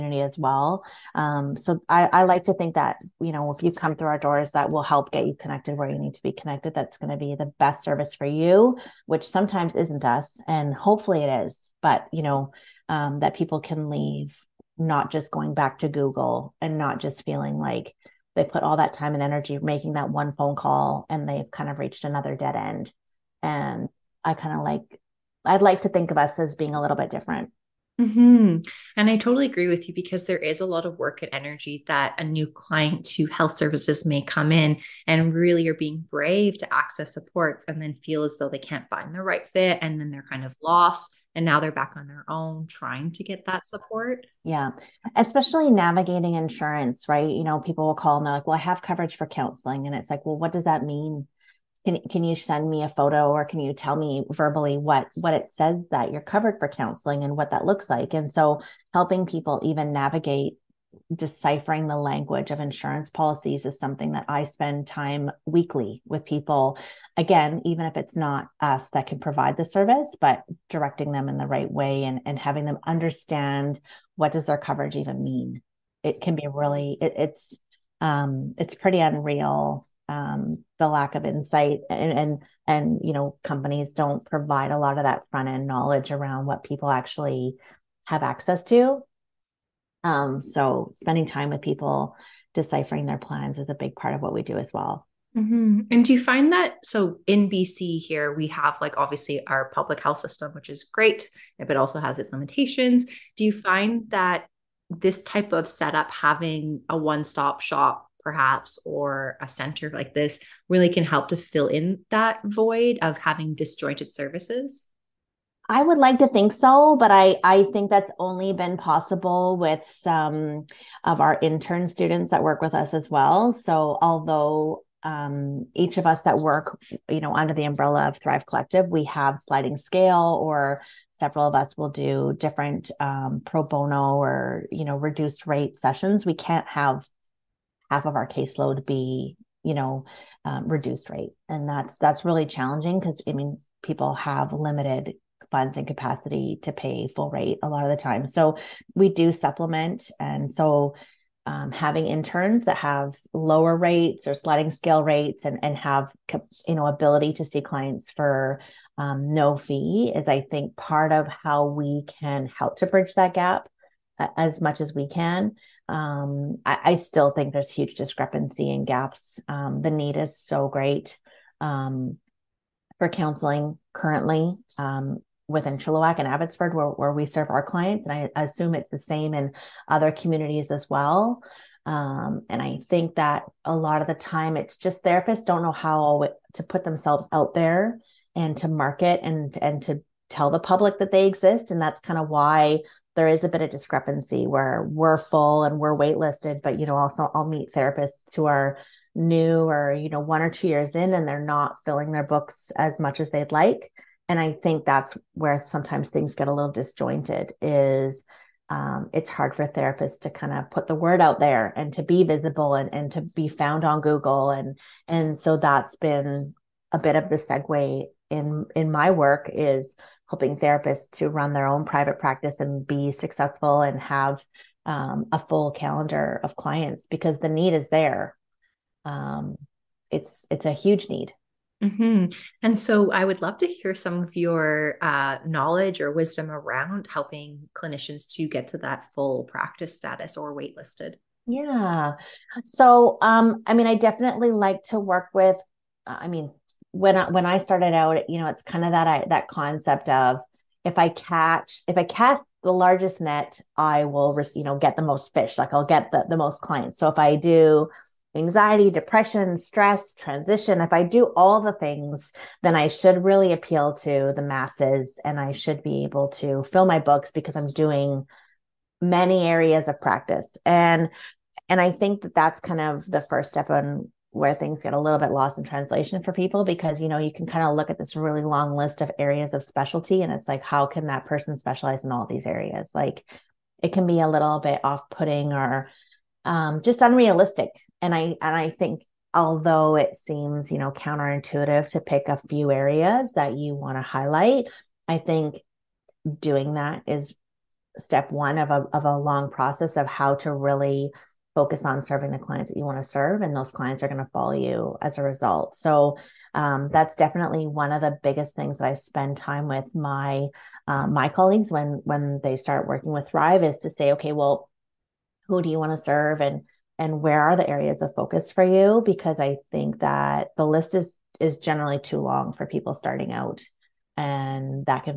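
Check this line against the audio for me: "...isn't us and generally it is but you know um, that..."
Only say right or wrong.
wrong.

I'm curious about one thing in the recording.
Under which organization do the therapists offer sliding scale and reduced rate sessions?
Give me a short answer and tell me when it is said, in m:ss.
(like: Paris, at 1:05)
Thrive Collective, at 2:08.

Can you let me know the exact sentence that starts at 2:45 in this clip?
Um, I, I, still think there's huge discrepancy and gaps.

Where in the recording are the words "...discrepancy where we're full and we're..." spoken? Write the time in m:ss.
3:13.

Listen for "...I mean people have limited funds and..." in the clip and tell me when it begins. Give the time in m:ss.
2:23.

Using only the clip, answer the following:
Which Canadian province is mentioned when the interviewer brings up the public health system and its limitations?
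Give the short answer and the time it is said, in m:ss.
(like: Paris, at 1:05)
BC, at 1:37.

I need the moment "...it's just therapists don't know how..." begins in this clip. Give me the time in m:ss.
3:04.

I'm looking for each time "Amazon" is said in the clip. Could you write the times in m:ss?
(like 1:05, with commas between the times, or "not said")
not said.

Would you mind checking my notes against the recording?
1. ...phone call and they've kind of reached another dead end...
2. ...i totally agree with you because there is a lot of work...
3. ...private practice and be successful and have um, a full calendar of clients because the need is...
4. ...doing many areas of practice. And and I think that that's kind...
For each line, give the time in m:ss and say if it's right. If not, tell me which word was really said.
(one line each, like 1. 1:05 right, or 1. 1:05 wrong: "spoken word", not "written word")
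1. 0:20 right
2. 0:29 right
3. 3:41 right
4. 4:27 right.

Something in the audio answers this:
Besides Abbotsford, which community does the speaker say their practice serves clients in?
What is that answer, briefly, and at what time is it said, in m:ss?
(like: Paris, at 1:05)
Chilliwack, at 2:55.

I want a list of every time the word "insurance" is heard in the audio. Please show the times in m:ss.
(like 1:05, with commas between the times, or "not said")
0:46, 1:02.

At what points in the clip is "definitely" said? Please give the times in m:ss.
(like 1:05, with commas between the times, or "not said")
4:03, 5:07.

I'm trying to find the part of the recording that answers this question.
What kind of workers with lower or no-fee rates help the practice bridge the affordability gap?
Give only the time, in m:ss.
2:01.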